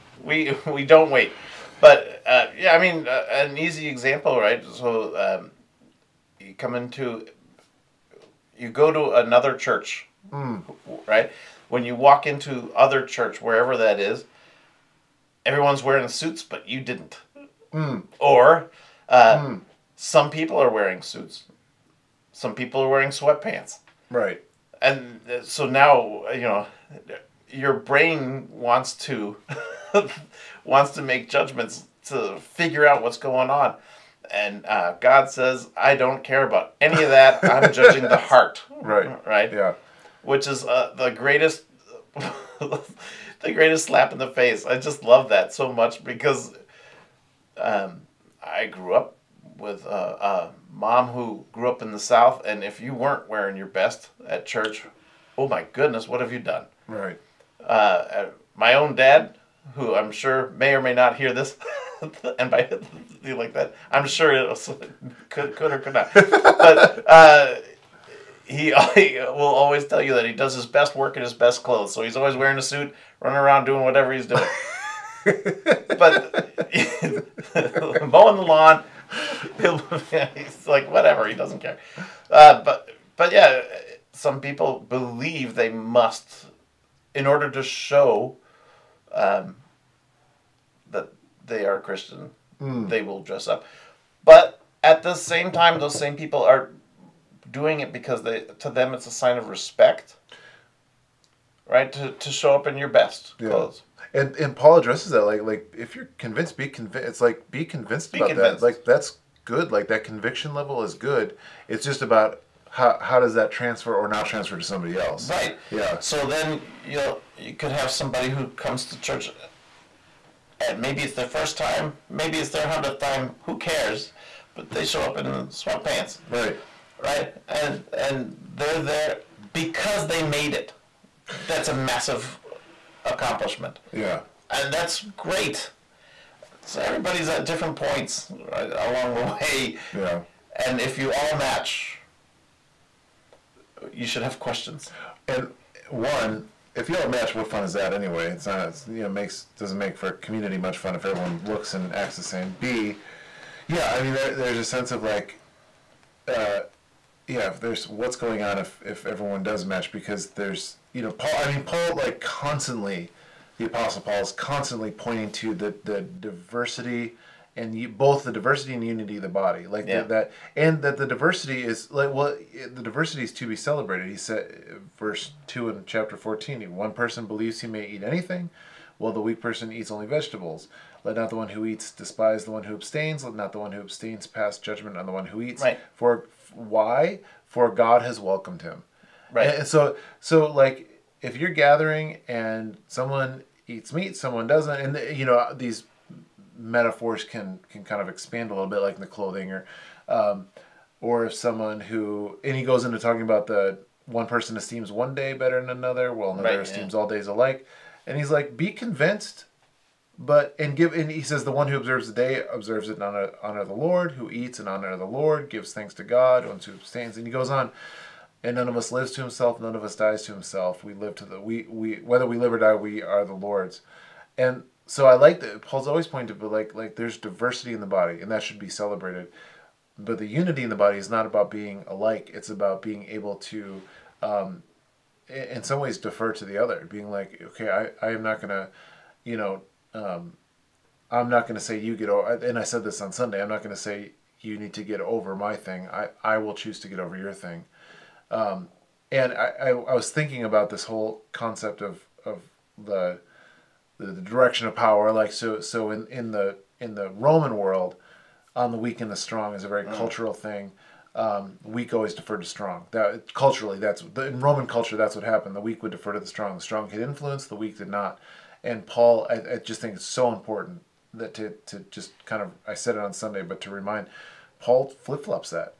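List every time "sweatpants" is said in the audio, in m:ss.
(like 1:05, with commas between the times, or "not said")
0:23, 2:05.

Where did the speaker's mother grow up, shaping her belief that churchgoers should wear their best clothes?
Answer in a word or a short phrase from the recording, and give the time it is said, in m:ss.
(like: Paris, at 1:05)
The South, at 0:51.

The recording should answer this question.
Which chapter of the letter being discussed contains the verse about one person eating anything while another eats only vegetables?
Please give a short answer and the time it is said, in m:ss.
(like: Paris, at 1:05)
Chapter 14, at 2:55.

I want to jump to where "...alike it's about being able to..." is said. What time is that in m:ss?
3:51.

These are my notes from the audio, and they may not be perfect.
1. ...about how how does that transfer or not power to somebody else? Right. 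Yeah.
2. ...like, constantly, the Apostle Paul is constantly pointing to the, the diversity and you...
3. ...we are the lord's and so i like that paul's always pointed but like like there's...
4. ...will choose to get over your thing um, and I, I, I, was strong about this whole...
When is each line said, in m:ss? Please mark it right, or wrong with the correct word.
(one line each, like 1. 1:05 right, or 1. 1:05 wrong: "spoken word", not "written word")
1. 1:52 wrong: "transfer", not "power"
2. 2:41 right
3. 3:42 right
4. 4:06 wrong: "thinking", not "strong".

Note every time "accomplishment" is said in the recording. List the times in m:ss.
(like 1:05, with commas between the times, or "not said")
2:13.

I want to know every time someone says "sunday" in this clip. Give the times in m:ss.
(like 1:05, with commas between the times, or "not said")
4:03, 4:33.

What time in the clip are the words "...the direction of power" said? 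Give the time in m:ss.
4:13.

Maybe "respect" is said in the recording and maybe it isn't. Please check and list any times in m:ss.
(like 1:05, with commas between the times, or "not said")
1:39.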